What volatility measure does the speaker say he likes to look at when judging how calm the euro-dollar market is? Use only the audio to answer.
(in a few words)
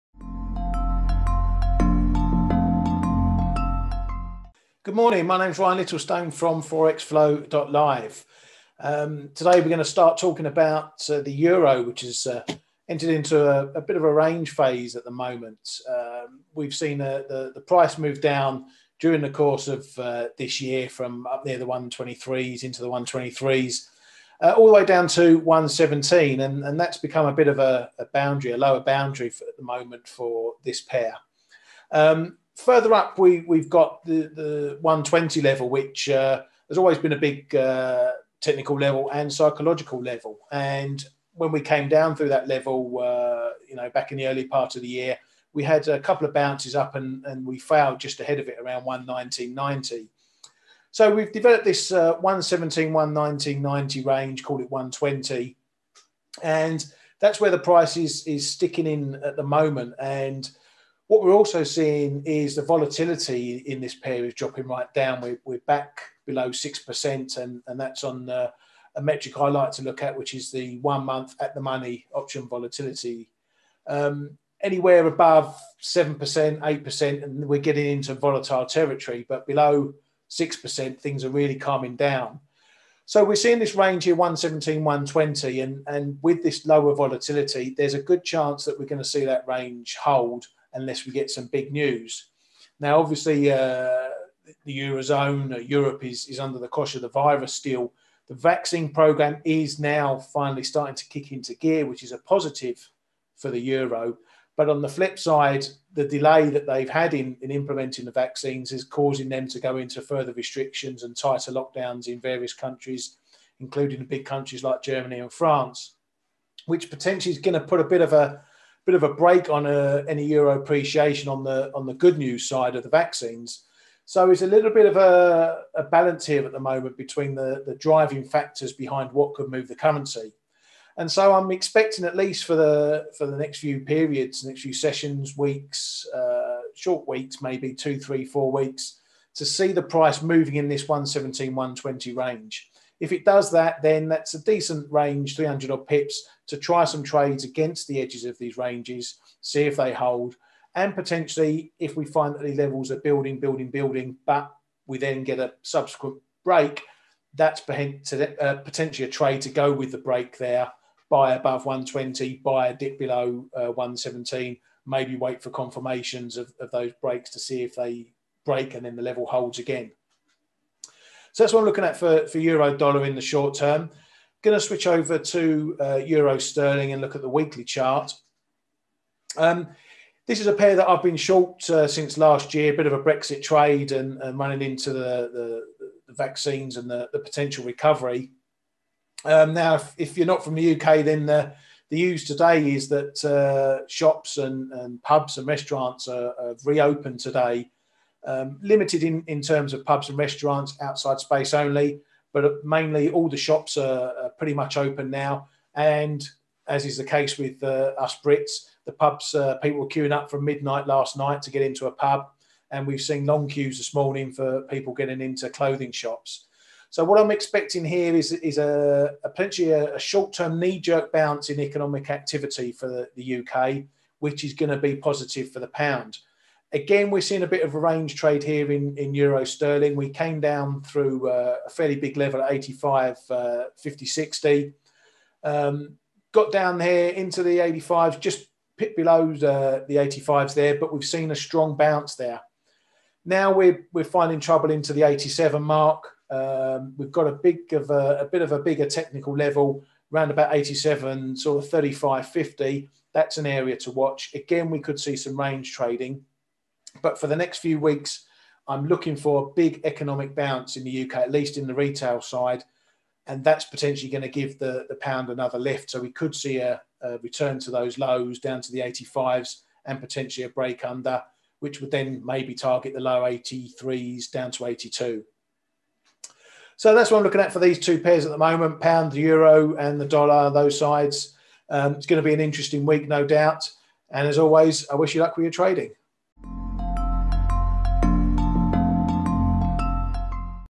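one month at the money option volatility.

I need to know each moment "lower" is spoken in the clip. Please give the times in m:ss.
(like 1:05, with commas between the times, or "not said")
0:28, 1:26.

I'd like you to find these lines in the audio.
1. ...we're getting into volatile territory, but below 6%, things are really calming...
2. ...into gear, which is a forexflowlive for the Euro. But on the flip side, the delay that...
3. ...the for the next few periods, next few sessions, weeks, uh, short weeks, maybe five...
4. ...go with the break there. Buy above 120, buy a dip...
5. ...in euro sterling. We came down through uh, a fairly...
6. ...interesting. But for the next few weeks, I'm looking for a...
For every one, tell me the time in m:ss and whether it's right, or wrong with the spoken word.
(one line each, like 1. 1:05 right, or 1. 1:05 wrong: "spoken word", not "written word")
1. 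1:17 right
2. 1:41 wrong: "positive", not "forexflowlive"
3. 2:12 wrong: "two", not "five"
4. 2:39 right
5. 3:48 right
6. 4:15 wrong: "trading", not "interesting".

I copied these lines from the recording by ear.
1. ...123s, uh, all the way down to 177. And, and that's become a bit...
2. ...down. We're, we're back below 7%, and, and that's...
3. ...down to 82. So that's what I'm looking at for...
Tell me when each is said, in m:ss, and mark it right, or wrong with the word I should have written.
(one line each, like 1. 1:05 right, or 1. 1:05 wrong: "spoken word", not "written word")
1. 0:22 wrong: "117", not "177"
2. 1:04 wrong: "6", not "7"
3. 4:34 right.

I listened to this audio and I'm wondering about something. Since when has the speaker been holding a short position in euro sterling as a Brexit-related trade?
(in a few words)
since last year.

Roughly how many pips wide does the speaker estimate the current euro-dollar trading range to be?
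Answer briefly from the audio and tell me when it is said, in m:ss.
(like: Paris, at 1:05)
300, at 2:25.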